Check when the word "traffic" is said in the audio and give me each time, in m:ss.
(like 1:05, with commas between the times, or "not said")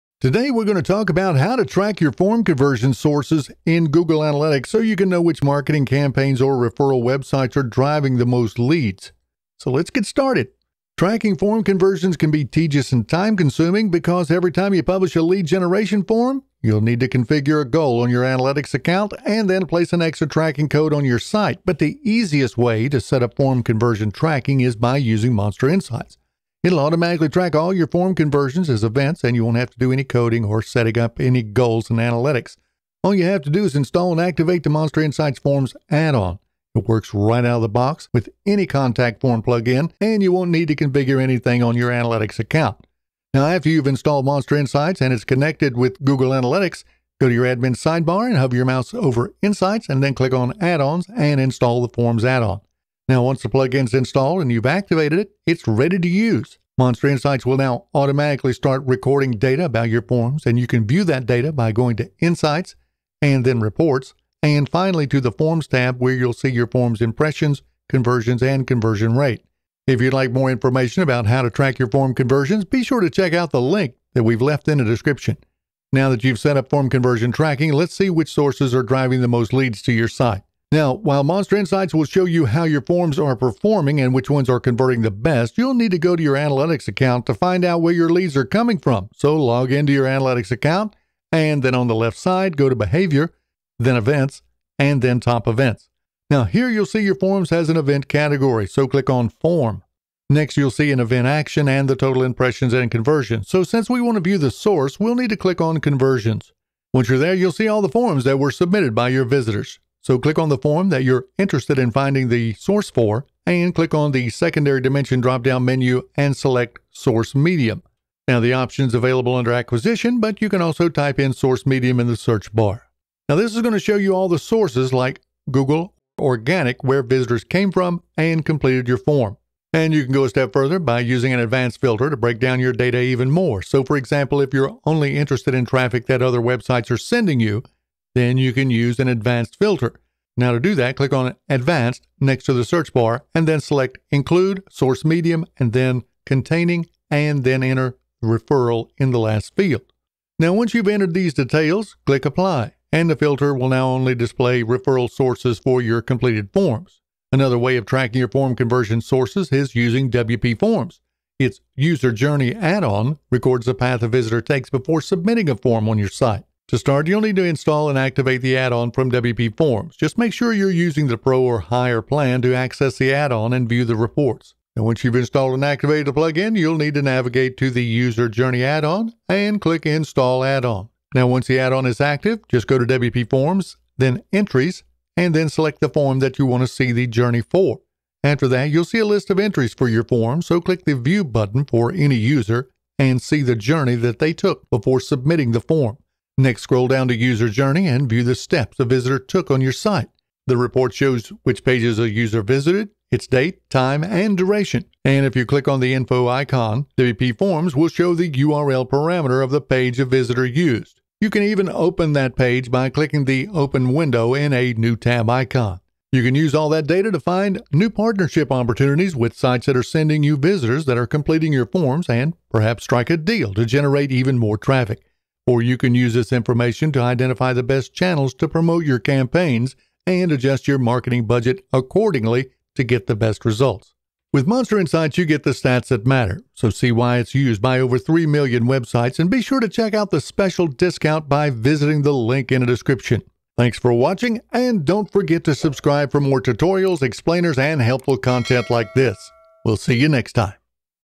2:15, 3:44.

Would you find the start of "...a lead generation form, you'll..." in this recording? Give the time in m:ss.
0:15.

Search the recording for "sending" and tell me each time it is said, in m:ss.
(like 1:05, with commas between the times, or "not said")
2:16, 3:39.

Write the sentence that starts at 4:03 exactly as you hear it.
Thanks for watching, and don't forget to subscribe for more tutorials, explainers, and helpful content like this.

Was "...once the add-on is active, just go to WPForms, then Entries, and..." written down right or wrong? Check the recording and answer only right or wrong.
right.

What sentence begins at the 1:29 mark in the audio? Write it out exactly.
So log into your analytics account, and then on the left side, go to Behavior, then Events, and then Top Events.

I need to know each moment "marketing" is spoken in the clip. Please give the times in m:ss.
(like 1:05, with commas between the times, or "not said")
0:05, 3:50.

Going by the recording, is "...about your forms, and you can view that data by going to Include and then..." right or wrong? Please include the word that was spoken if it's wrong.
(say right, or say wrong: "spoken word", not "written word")
wrong: "Insights", not "Include".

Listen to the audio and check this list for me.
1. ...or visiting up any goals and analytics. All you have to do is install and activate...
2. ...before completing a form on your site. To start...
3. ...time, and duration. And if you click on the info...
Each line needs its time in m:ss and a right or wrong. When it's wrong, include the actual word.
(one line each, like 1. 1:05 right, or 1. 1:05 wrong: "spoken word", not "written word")
1. 0:30 wrong: "setting", not "visiting"
2. 2:44 wrong: "submitting", not "completing"
3. 3:23 right.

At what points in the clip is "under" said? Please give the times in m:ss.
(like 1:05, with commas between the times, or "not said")
1:59.